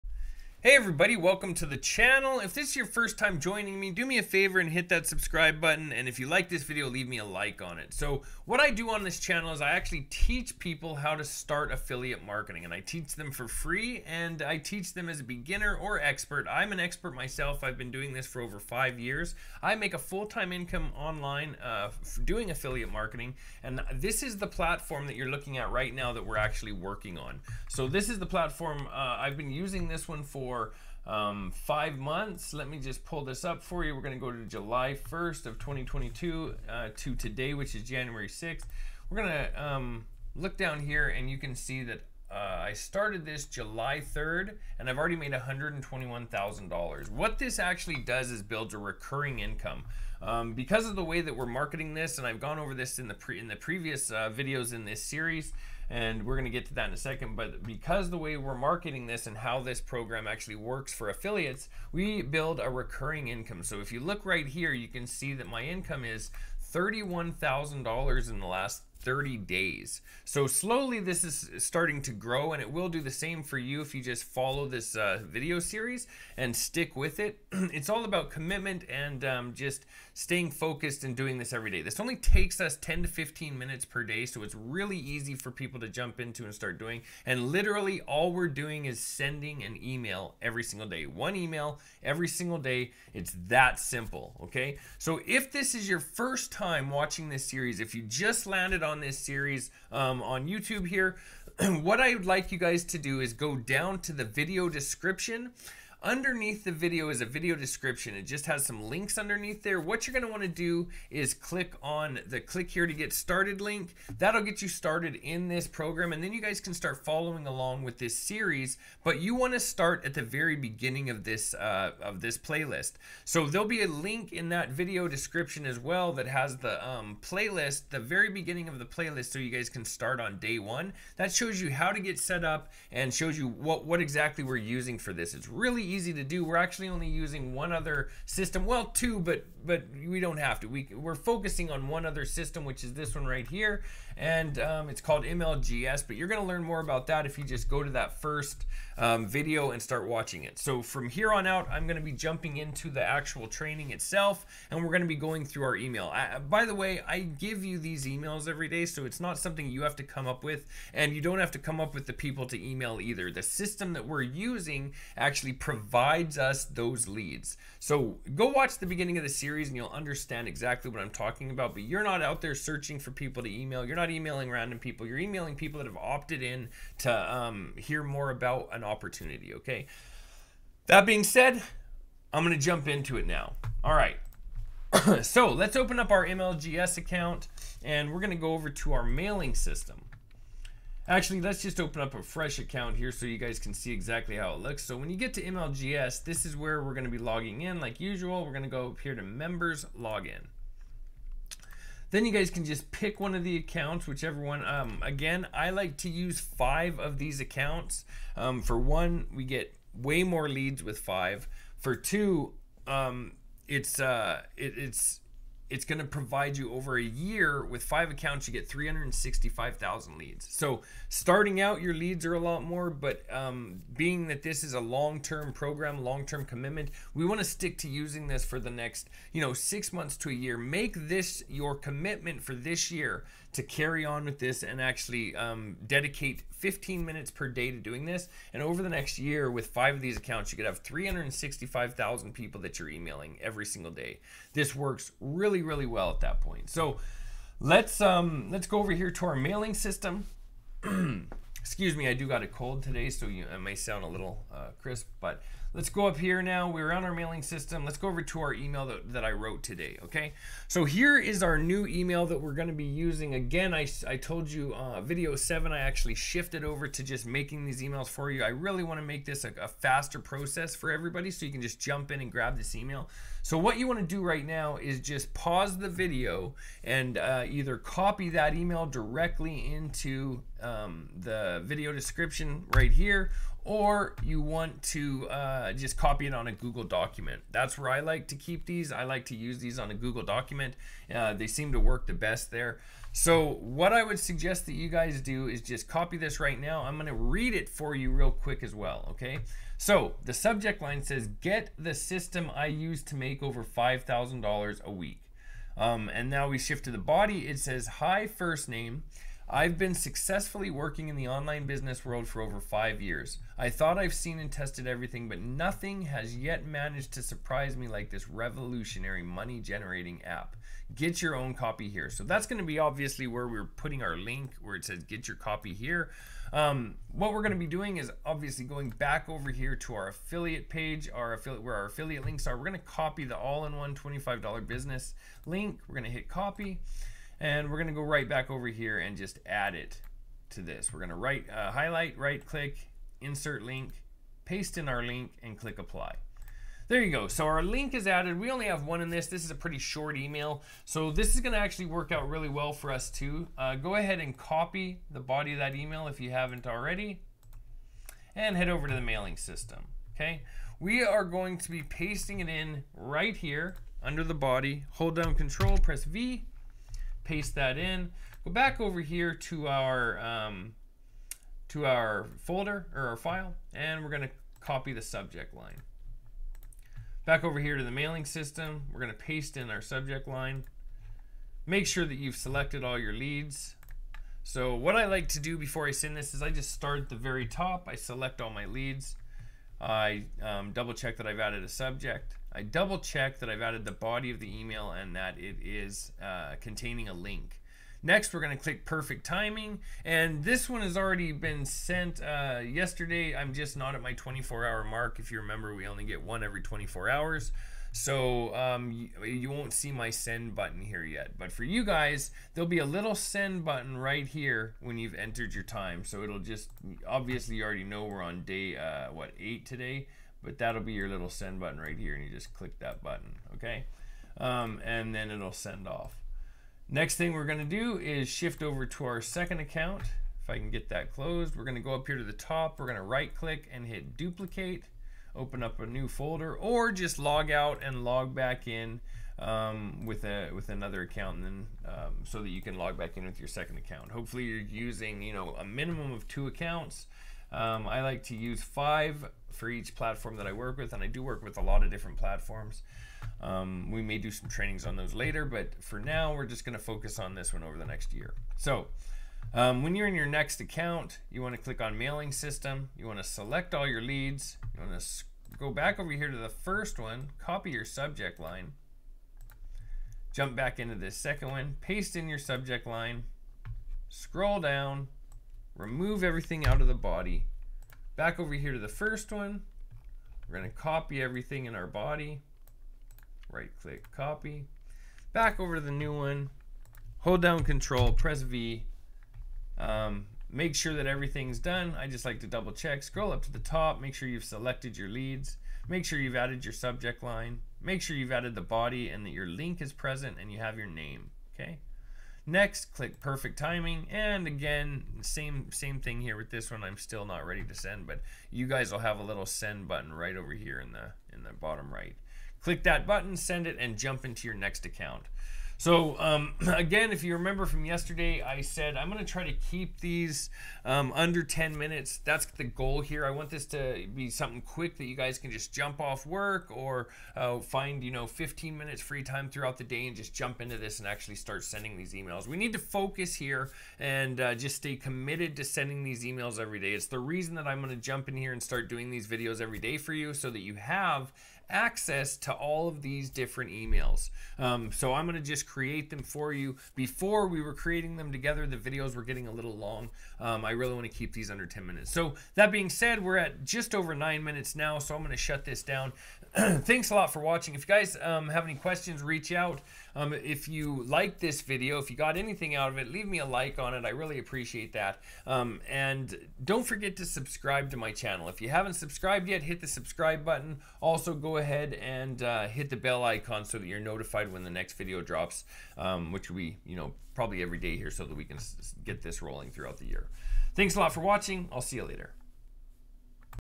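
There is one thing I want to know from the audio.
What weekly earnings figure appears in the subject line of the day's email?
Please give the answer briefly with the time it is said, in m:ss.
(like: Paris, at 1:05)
$5,000, at 5:03.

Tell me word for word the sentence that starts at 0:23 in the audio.
And this is the platform that you're looking at right now that we're actually working on.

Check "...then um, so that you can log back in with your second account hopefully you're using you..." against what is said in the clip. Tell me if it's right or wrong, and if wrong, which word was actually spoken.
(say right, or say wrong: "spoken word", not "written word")
right.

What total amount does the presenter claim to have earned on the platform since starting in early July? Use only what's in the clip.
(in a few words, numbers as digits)
$121,000.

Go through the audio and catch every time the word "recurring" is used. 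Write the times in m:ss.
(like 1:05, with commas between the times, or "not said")
0:48, 1:02.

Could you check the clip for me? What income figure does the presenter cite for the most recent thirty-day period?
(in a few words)
$31,000.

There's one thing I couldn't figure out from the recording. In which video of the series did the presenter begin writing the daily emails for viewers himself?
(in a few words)
video 7.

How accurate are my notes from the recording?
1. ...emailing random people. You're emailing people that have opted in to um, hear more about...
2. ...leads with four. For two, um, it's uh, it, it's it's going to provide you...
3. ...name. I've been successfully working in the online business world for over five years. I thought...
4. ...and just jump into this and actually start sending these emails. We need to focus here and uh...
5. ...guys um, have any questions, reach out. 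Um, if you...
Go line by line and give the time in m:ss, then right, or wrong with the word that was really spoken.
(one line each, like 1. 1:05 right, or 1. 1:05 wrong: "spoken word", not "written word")
1. 2:54 right
2. 3:30 wrong: "five", not "four"
3. 5:08 right
4. 8:50 right
5. 9:17 right.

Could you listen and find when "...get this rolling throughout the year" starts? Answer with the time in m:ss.
9:39.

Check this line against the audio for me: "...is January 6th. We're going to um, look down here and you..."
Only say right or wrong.
right.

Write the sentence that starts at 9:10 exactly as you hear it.
Um, I really want to keep these under 10 minutes.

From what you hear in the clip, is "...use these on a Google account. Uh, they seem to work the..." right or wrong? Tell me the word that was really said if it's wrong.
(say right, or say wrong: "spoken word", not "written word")
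wrong: "document", not "account".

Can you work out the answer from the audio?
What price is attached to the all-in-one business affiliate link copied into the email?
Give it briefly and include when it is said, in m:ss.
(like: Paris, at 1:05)
$25, at 5:33.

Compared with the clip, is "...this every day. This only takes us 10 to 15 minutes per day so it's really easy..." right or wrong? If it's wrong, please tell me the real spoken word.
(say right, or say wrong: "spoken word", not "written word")
right.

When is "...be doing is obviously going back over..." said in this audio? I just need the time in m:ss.
5:27.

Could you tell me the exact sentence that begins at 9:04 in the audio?
Um, so I'm going to just create them for you.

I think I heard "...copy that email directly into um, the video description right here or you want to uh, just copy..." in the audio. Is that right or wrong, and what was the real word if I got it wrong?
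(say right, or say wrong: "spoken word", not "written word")
right.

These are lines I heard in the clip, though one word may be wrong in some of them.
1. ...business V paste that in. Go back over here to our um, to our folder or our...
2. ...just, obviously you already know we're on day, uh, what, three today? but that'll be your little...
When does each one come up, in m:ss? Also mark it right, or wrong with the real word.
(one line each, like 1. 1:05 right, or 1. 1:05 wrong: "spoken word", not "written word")
1. 6:05 wrong: "press", not "business"
2. 6:56 wrong: "eight", not "three".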